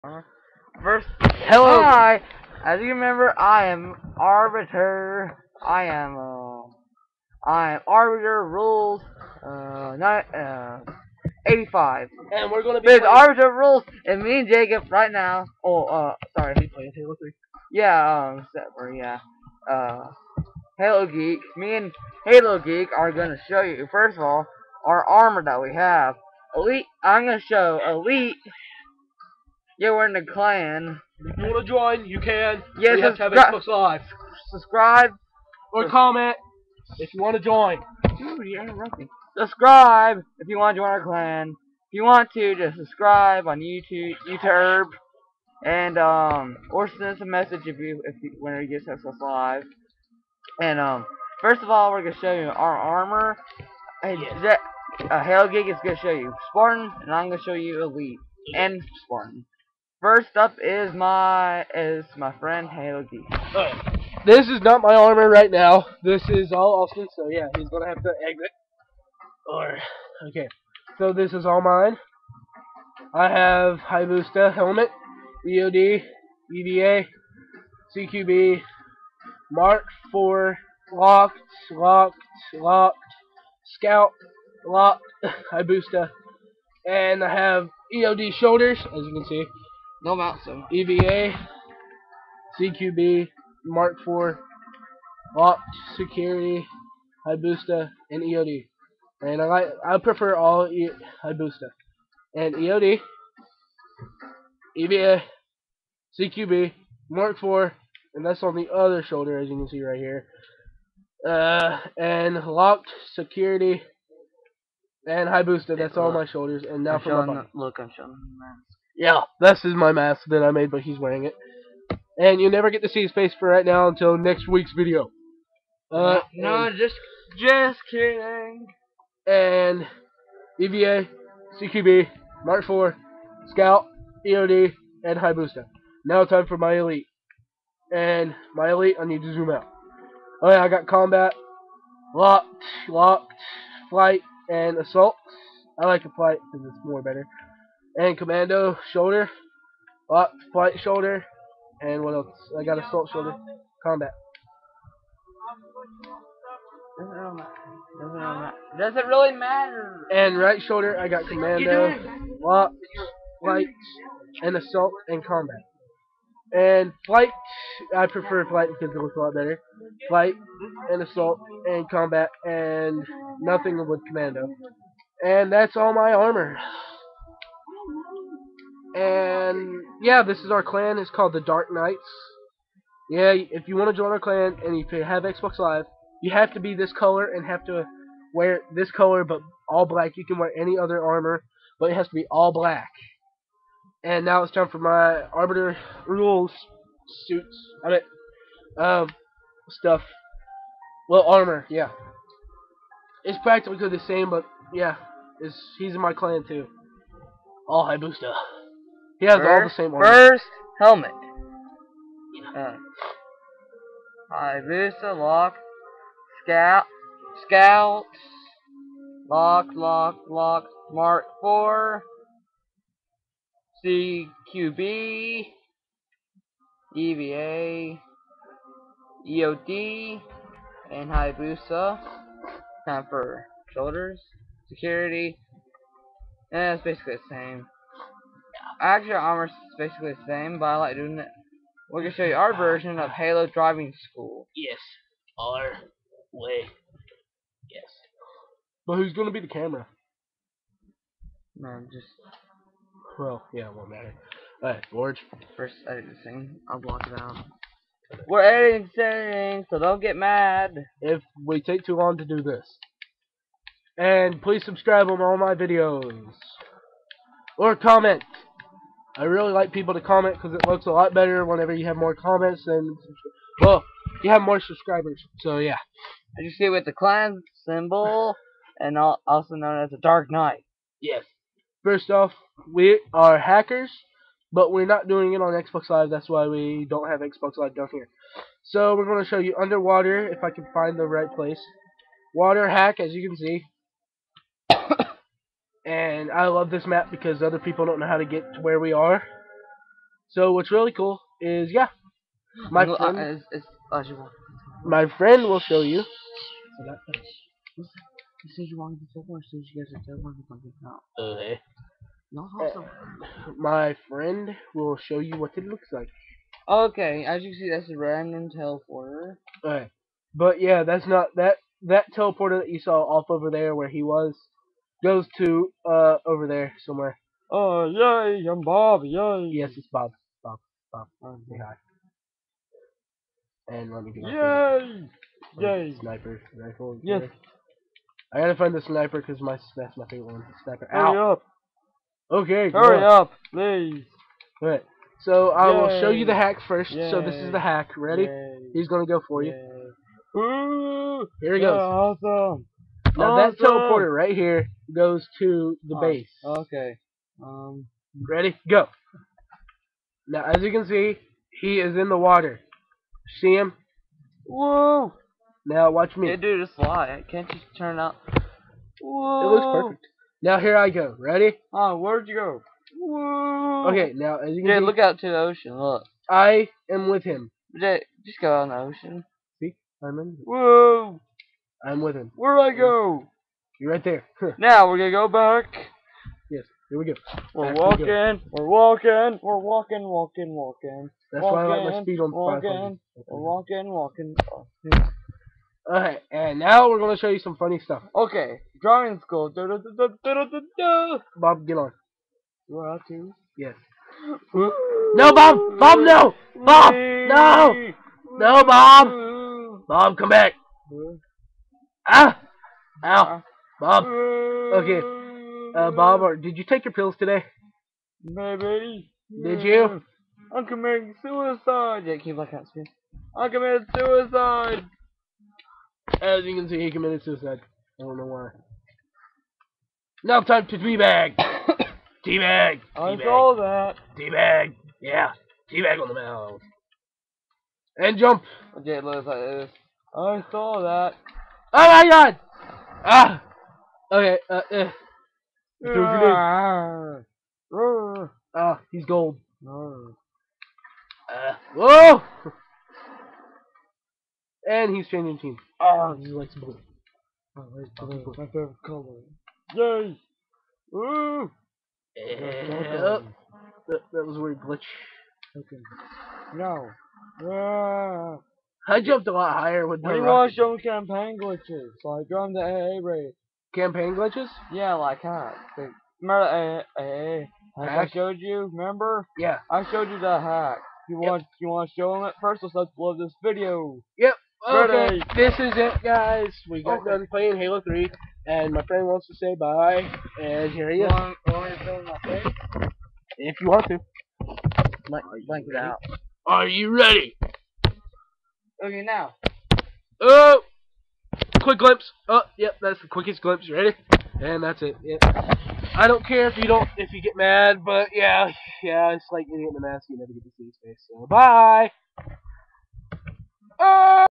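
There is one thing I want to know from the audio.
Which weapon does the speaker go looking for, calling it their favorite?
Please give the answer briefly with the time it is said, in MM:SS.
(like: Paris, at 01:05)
Sniper rifle, at 05:35.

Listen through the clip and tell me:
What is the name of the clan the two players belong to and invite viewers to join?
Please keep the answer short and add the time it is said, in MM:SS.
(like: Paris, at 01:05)
The Dark Knights, at 03:01.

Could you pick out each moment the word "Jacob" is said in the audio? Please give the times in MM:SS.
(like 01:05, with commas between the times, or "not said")
00:14.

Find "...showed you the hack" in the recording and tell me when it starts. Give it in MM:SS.
07:59.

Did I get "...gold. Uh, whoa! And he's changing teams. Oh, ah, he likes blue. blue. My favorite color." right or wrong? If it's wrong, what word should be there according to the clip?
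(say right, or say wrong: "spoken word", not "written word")
right.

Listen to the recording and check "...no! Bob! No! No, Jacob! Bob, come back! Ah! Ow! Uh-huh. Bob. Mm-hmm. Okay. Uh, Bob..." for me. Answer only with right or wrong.
wrong.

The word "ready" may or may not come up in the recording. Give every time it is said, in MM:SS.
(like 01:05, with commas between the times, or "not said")
05:47, 05:58, 06:11, 08:04, 08:16, 08:23.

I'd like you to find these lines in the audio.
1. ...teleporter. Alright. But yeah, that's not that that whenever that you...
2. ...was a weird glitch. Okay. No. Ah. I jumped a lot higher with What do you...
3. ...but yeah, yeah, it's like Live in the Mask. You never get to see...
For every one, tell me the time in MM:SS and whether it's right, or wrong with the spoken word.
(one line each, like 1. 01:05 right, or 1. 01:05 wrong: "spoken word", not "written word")
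1. 05:18 wrong: "teleporter", not "whenever"
2. 07:44 right
3. 08:27 wrong: "Idiot", not "Live".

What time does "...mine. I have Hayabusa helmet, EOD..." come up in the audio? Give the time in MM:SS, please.
01:11.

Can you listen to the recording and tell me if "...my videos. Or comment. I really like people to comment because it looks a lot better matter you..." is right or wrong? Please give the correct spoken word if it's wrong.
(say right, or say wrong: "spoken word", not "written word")
wrong: "whenever", not "matter".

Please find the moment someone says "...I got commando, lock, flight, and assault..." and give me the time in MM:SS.
02:40.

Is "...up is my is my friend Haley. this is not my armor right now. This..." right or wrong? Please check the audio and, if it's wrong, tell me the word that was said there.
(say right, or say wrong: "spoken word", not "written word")
right.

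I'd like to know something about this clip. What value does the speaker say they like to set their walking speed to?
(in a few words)
500.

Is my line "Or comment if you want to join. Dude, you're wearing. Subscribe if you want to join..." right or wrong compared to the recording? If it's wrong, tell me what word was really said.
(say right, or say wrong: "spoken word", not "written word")
wrong: "interrupting", not "wearing".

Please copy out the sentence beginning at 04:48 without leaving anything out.
So we're going to show you underwater if I can find the right place.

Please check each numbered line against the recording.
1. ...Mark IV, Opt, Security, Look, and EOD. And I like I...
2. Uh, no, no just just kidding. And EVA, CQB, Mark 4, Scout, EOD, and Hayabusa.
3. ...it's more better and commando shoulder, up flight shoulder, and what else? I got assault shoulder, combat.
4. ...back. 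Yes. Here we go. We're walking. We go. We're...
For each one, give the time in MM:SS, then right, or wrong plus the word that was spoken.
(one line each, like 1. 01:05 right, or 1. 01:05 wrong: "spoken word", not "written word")
1. 01:33 wrong: "Hayabusa", not "Look"
2. 02:05 right
3. 02:26 right
4. 06:25 right.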